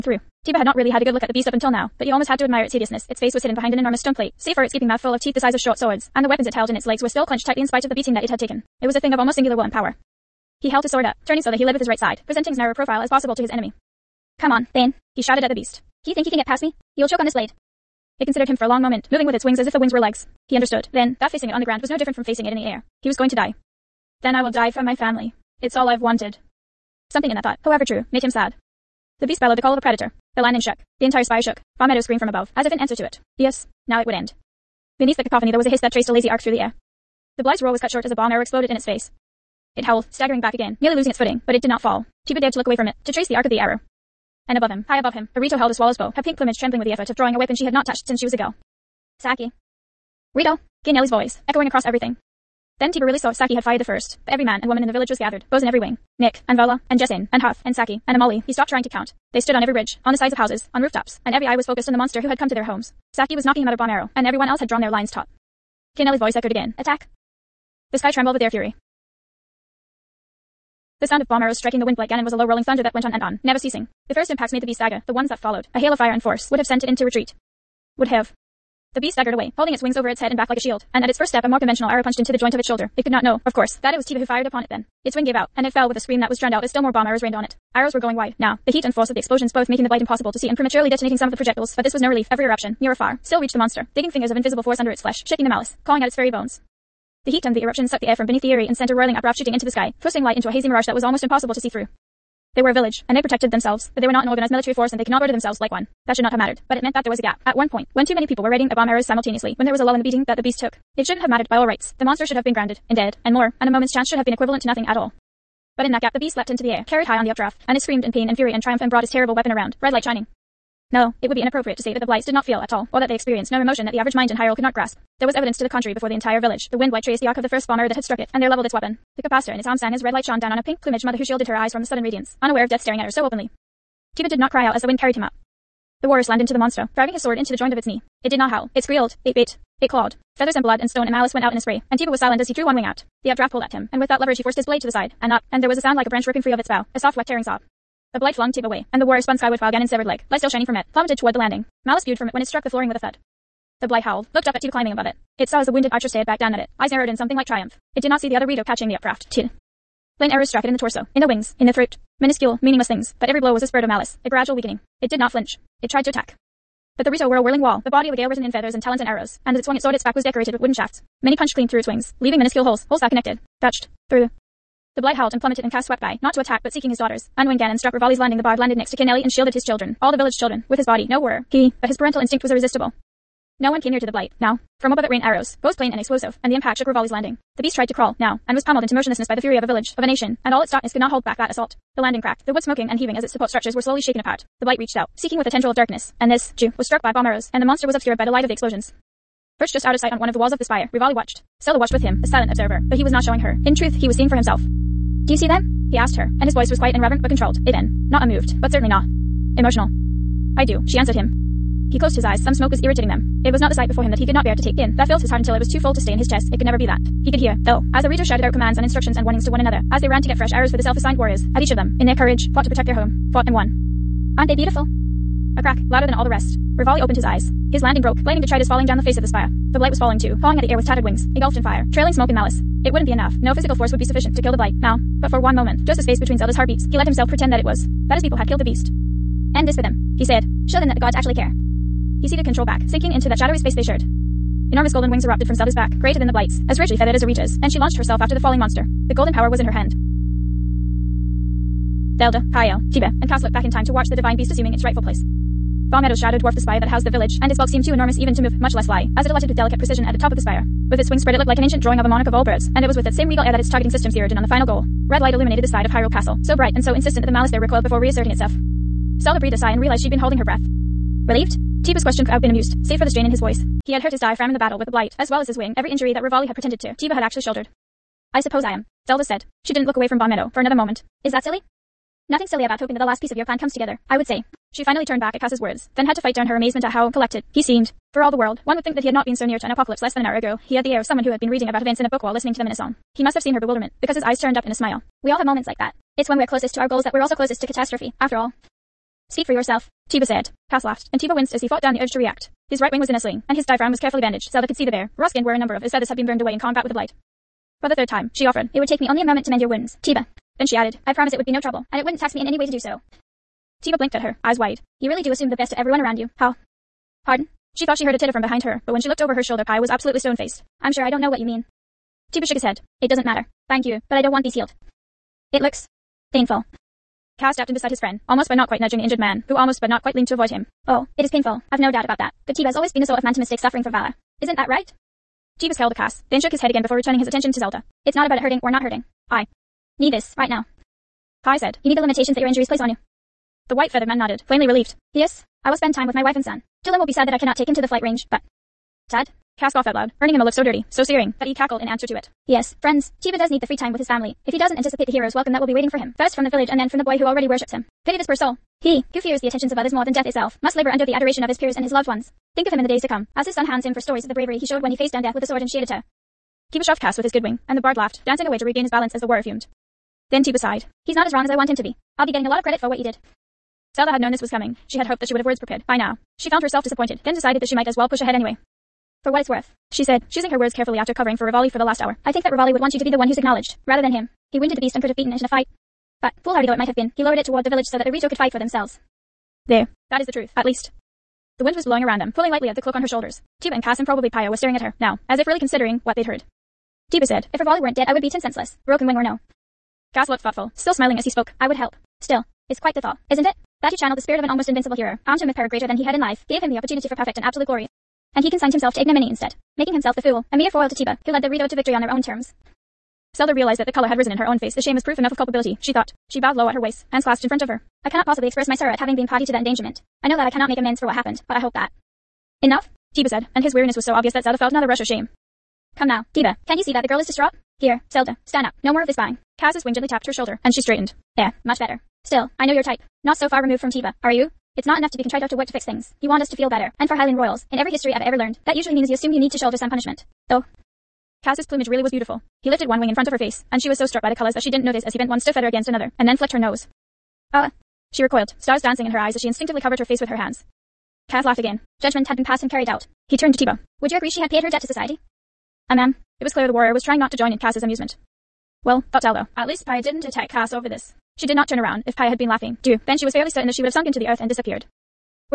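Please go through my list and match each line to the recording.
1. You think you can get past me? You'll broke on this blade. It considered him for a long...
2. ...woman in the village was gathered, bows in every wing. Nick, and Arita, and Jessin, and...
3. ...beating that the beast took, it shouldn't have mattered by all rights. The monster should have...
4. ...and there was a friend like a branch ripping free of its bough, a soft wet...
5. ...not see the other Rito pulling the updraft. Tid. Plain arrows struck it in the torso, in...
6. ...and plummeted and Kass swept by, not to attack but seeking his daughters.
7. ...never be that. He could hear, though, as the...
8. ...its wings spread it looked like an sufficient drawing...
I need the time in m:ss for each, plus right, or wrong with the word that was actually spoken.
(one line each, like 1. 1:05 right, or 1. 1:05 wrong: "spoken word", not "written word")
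1. 0:16 wrong: "choke", not "broke"
2. 0:54 wrong: "Vola", not "Arita"
3. 1:50 right
4. 2:25 wrong: "sound", not "friend"
5. 2:38 wrong: "catching", not "pulling"
6. 2:55 right
7. 3:36 right
8. 4:20 wrong: "ancient", not "sufficient".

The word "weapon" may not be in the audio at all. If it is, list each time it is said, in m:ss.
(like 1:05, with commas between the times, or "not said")
0:06, 0:47, 1:59, 2:08.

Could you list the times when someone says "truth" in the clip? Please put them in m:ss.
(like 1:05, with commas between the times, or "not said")
3:23, 6:30.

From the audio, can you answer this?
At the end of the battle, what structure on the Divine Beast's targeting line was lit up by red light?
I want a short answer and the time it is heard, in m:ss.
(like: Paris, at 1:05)
Hyrule Castle, at 4:25.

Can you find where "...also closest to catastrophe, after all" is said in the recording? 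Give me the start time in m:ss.
4:57.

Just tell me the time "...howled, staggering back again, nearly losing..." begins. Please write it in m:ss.
0:39.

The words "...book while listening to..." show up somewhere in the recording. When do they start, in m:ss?
4:52.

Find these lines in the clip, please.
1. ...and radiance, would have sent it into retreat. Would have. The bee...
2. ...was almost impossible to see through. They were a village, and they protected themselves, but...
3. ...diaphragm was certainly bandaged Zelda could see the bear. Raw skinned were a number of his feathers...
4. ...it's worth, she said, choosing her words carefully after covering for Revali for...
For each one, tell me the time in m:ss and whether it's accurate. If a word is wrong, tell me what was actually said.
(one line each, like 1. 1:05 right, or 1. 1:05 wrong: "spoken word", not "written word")
1. 1:16 wrong: "force", not "radiance"
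2. 1:40 right
3. 5:03 wrong: "carefully", not "certainly"
4. 6:19 right.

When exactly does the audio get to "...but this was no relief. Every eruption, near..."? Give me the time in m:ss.
1:31.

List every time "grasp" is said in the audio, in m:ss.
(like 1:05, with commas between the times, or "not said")
2:04.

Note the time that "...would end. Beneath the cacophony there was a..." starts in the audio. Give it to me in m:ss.
0:34.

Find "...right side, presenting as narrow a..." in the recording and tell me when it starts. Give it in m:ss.
0:11.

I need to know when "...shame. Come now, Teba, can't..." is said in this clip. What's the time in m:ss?
7:05.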